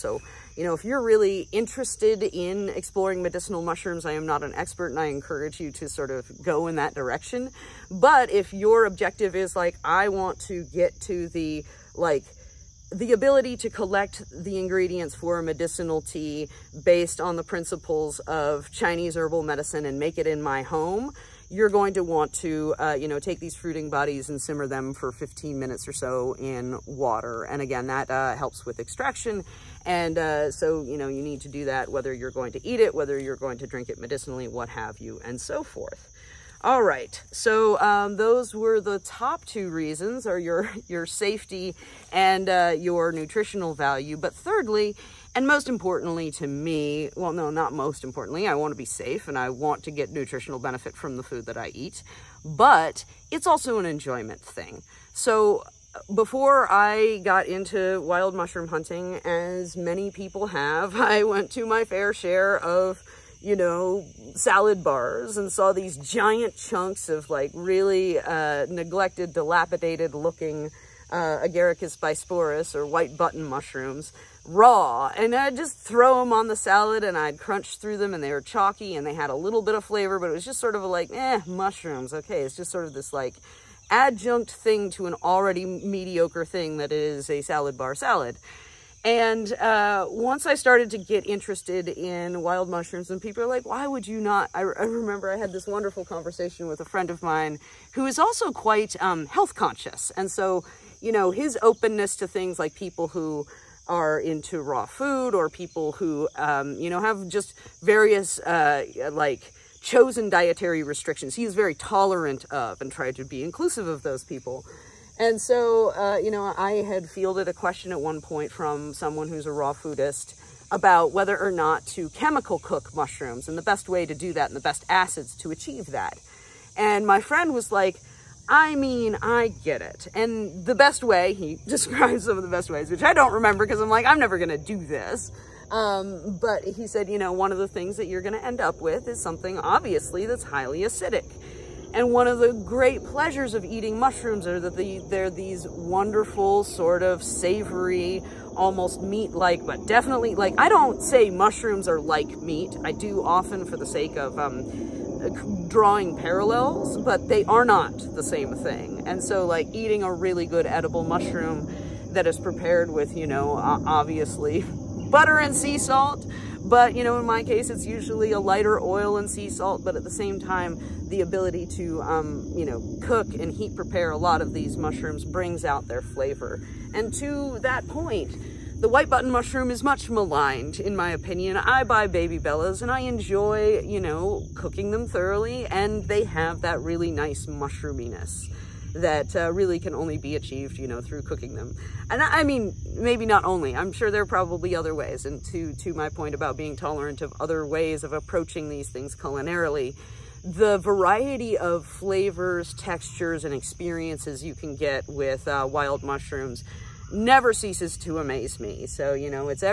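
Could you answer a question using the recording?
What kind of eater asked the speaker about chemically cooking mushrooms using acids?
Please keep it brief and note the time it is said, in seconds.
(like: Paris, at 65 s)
raw foodist, at 119 s.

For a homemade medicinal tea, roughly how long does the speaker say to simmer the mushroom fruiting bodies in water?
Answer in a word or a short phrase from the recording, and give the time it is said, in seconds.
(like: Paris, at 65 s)
15 minutes, at 25 s.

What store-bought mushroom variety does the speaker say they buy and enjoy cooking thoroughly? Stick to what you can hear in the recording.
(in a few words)
baby bellas.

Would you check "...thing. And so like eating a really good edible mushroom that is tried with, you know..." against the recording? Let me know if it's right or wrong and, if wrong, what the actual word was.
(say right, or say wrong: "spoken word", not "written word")
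wrong: "prepared", not "tried".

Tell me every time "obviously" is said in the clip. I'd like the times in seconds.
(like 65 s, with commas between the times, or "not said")
139 s, 163 s.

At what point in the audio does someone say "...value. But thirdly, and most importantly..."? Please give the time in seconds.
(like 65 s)
43 s.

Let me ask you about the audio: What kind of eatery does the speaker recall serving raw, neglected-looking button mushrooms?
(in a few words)
salad bars.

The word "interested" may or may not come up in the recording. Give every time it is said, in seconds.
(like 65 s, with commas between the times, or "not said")
1 s, 91 s.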